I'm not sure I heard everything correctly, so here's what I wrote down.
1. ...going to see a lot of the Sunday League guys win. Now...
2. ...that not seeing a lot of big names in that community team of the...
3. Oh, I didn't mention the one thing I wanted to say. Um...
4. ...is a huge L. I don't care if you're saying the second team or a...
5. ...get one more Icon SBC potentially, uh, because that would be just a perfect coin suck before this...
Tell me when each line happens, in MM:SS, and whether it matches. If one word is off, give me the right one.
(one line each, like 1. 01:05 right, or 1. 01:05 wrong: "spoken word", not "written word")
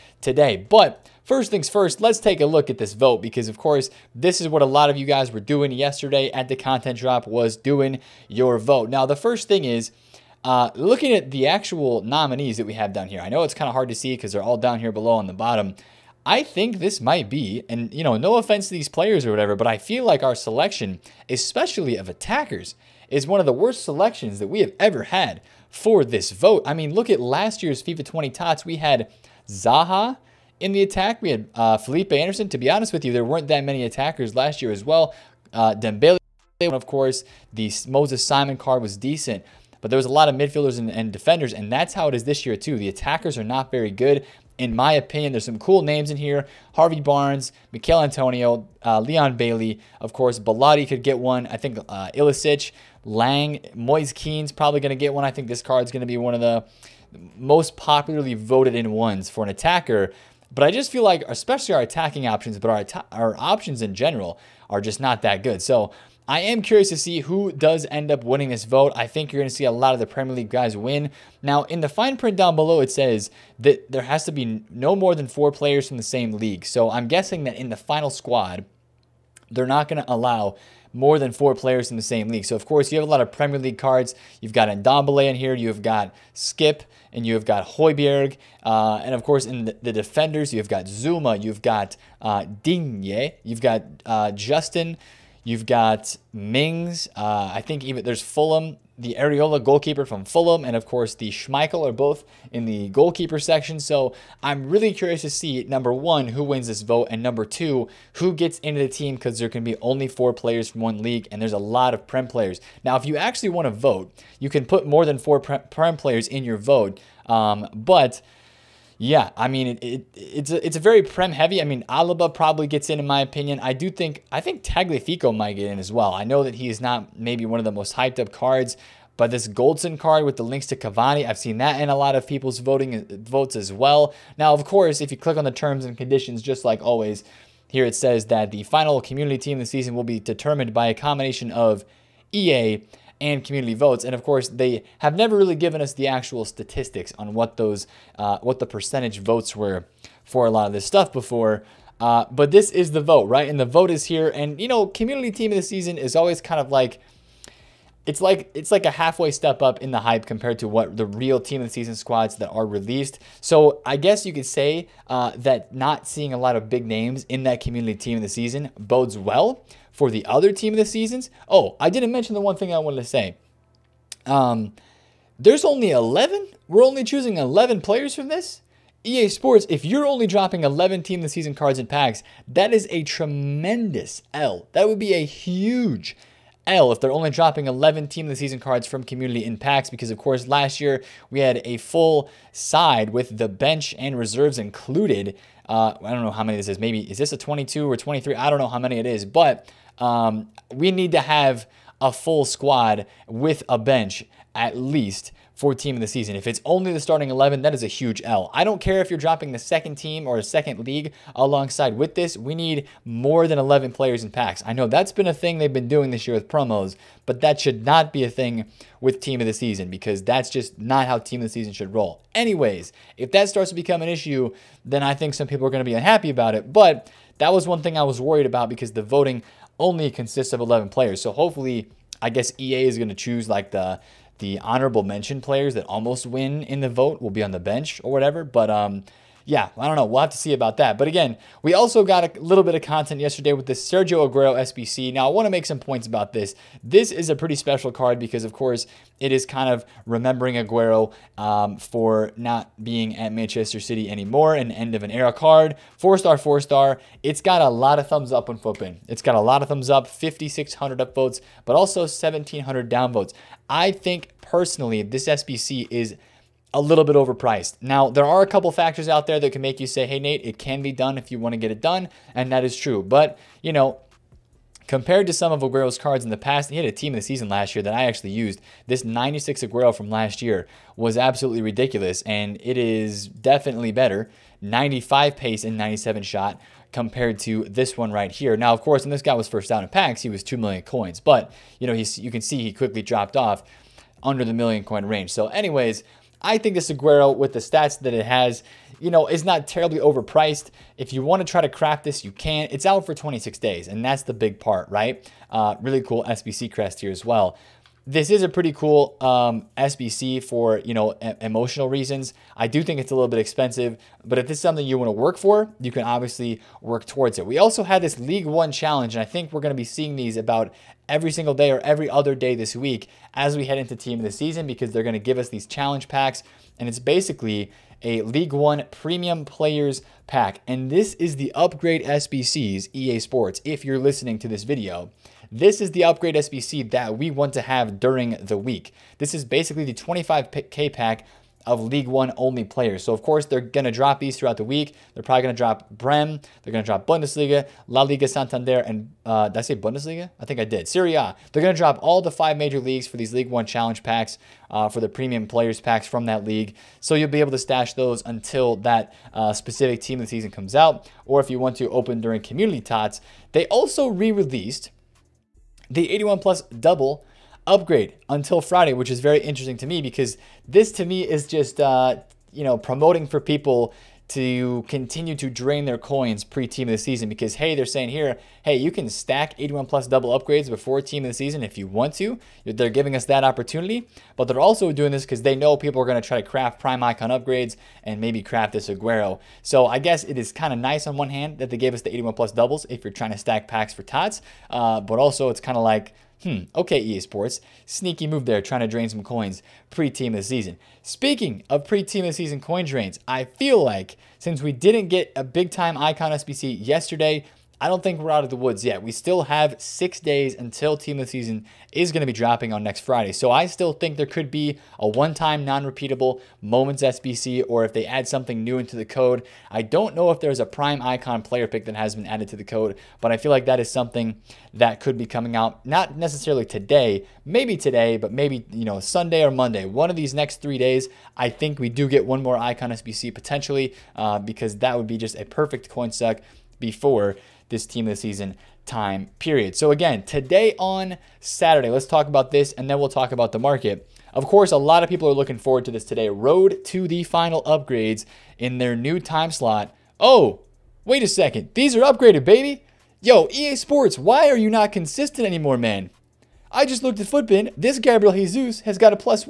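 1. 01:09 wrong: "Premier", not "Sunday"
2. 02:45 right
3. 02:51 right
4. 03:27 wrong: "dropping", not "saying"
5. 07:12 right.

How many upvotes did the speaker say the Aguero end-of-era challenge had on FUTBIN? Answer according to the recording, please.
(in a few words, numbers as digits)
5,600.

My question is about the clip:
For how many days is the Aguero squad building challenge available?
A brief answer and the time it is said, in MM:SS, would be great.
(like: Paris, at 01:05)
26 days, at 05:03.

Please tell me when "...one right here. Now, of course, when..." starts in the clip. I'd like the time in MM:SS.
04:47.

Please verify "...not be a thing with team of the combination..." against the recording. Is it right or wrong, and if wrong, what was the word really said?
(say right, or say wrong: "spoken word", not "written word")
wrong: "season", not "combination".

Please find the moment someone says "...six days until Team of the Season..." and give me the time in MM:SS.
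06:49.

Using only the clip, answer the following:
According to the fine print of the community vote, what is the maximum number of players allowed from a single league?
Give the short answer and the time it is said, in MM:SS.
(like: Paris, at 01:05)
4, at 01:14.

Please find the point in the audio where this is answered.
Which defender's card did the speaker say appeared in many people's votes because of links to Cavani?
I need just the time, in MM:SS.
02:09.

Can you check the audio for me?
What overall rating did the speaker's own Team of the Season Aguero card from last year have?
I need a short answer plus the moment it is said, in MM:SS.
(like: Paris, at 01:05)
96, at 04:39.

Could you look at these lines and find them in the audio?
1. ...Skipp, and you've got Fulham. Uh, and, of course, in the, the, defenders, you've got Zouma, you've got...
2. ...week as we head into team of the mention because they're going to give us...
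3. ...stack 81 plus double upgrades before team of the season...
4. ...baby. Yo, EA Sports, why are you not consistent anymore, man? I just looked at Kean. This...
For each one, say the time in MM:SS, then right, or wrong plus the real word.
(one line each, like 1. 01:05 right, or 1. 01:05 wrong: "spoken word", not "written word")
1. 01:26 wrong: "Hojbjerg", not "Fulham"
2. 05:22 wrong: "season", not "mention"
3. 06:19 right
4. 07:32 wrong: "FUTBIN", not "Kean".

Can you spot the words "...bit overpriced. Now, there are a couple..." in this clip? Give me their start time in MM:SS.
04:27.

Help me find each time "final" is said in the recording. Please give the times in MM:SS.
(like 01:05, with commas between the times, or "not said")
01:17, 02:18, 07:27.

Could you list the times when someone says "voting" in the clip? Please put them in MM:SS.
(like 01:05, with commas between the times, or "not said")
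02:12, 03:49.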